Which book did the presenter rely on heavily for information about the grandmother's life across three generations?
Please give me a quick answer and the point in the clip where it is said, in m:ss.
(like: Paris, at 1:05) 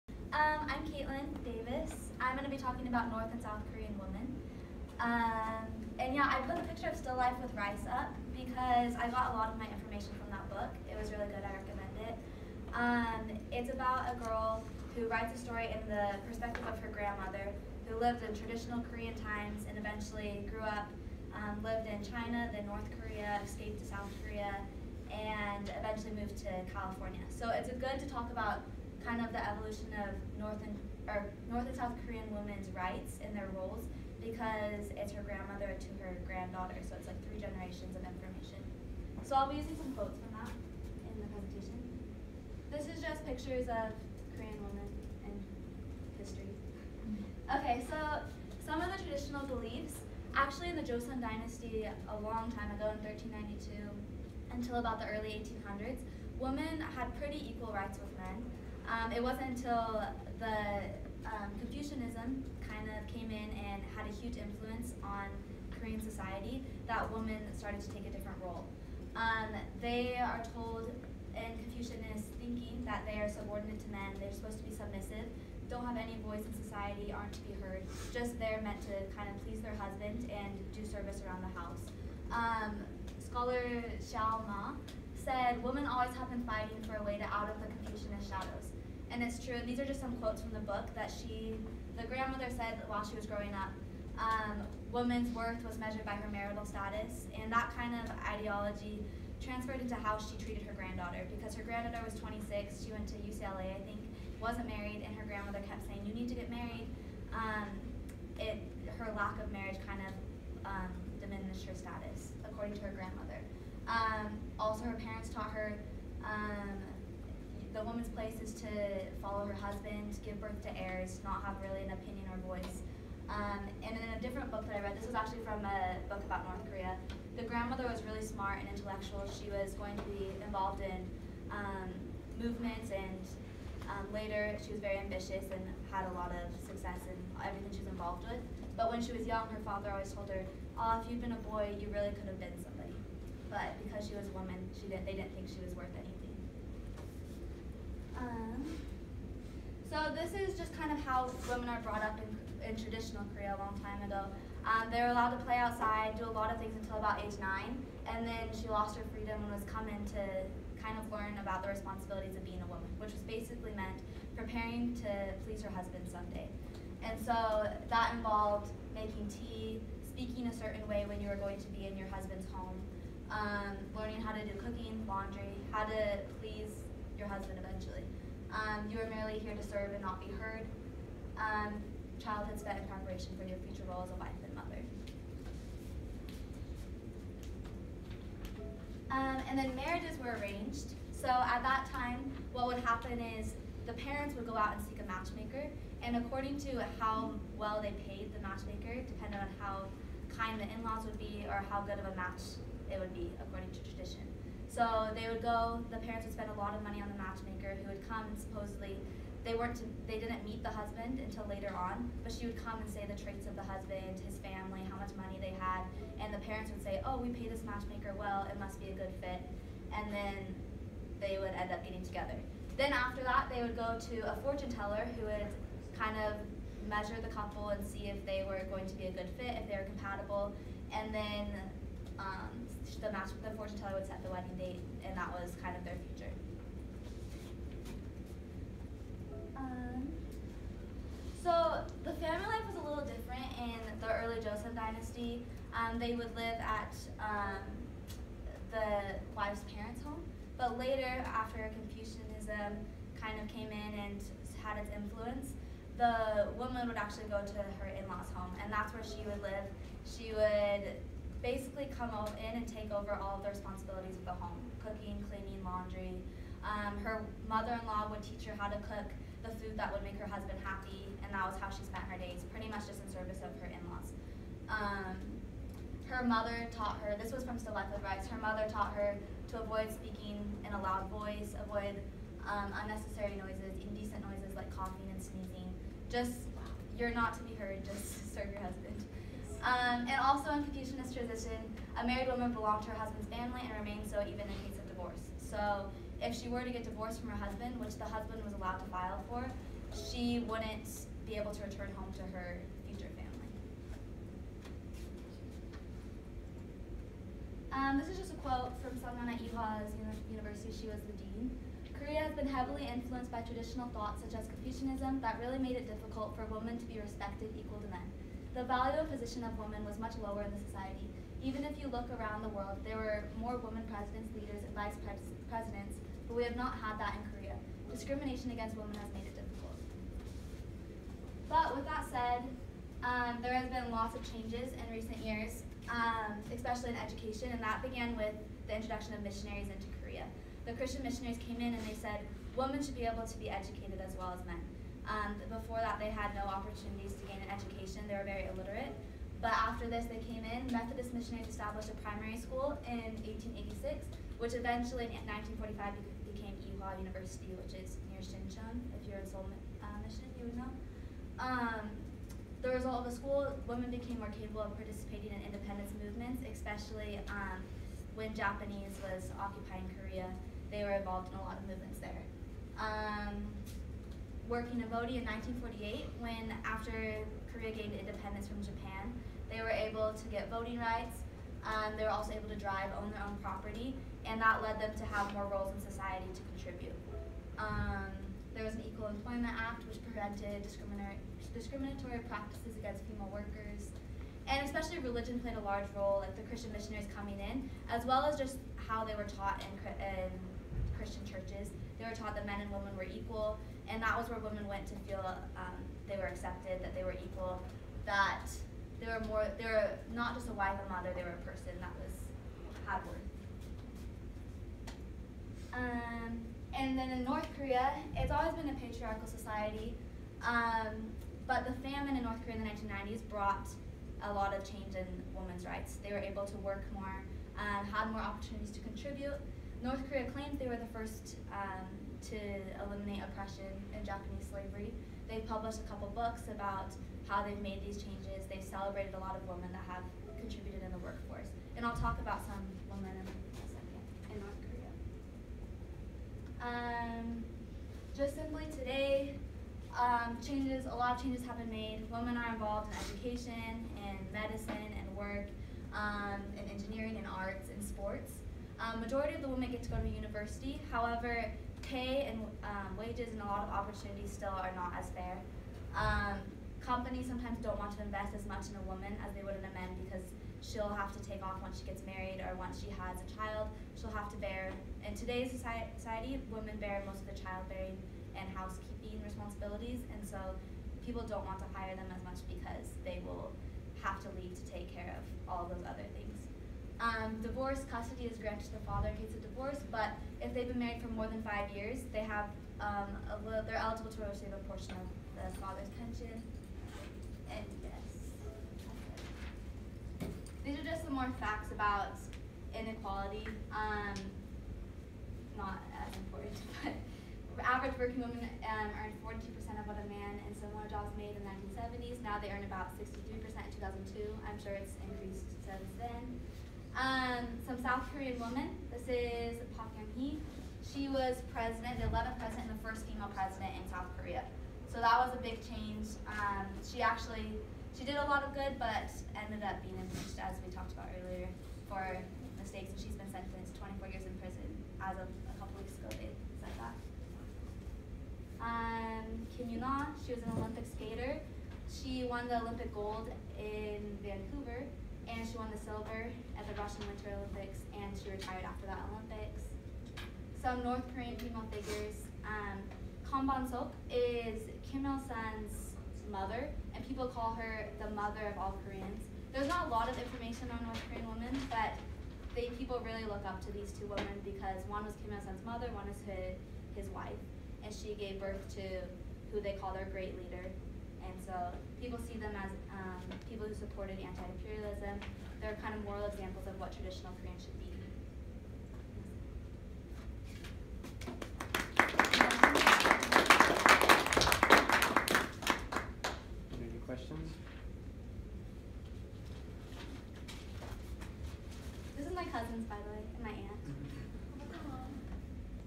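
Still Life with Rice, at 0:06.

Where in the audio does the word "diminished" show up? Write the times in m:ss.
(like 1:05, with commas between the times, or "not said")
1:51.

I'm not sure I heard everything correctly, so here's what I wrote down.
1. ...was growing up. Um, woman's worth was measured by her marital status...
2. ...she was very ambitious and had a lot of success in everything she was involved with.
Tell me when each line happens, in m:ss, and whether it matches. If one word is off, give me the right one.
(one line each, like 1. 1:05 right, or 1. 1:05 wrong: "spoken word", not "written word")
1. 1:33 right
2. 2:14 right.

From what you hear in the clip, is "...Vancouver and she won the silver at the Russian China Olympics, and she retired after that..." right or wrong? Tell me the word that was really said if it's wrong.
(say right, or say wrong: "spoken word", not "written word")
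wrong: "Winter", not "China".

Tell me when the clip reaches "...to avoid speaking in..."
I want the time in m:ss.
4:39.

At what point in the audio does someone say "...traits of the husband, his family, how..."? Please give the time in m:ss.
3:33.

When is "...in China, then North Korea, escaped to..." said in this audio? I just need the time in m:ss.
0:21.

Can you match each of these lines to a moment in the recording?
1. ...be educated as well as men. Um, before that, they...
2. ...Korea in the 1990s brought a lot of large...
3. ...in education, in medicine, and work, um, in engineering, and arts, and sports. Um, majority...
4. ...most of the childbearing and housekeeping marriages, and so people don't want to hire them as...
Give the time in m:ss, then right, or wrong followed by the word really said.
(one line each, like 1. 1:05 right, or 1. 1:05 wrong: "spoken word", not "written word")
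1. 5:43 right
2. 7:02 wrong: "change", not "large"
3. 7:32 right
4. 7:57 wrong: "responsibilities", not "marriages".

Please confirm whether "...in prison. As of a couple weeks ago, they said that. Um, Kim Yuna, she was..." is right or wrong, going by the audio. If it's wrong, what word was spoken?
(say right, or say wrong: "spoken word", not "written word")
right.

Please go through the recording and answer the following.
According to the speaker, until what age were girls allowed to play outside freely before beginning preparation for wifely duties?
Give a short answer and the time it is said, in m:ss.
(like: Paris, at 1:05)
9, at 2:37.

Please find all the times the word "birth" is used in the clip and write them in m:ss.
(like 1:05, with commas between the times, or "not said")
2:00, 9:28.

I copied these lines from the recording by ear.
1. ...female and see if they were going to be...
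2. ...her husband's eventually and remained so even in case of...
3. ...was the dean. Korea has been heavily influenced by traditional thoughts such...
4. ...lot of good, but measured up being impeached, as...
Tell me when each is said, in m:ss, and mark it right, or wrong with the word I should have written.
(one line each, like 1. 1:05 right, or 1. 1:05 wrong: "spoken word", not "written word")
1. 3:47 wrong: "couple", not "female"
2. 4:52 wrong: "family", not "eventually"
3. 5:10 right
4. 8:48 wrong: "ended", not "measured".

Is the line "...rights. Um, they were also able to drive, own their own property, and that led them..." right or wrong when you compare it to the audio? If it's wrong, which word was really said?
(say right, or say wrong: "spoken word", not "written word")
right.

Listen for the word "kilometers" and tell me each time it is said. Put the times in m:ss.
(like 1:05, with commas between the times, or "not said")
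not said.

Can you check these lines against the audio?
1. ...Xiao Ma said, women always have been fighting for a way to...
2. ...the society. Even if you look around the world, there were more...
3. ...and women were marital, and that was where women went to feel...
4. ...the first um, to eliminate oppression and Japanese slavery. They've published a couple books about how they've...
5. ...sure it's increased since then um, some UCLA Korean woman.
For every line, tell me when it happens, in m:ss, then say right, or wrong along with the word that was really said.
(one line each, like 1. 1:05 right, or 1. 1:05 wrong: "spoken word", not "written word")
1. 1:24 right
2. 5:20 right
3. 6:42 wrong: "equal", not "marital"
4. 7:10 right
5. 8:34 wrong: "South", not "UCLA".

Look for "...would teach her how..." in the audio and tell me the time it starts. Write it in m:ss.
4:28.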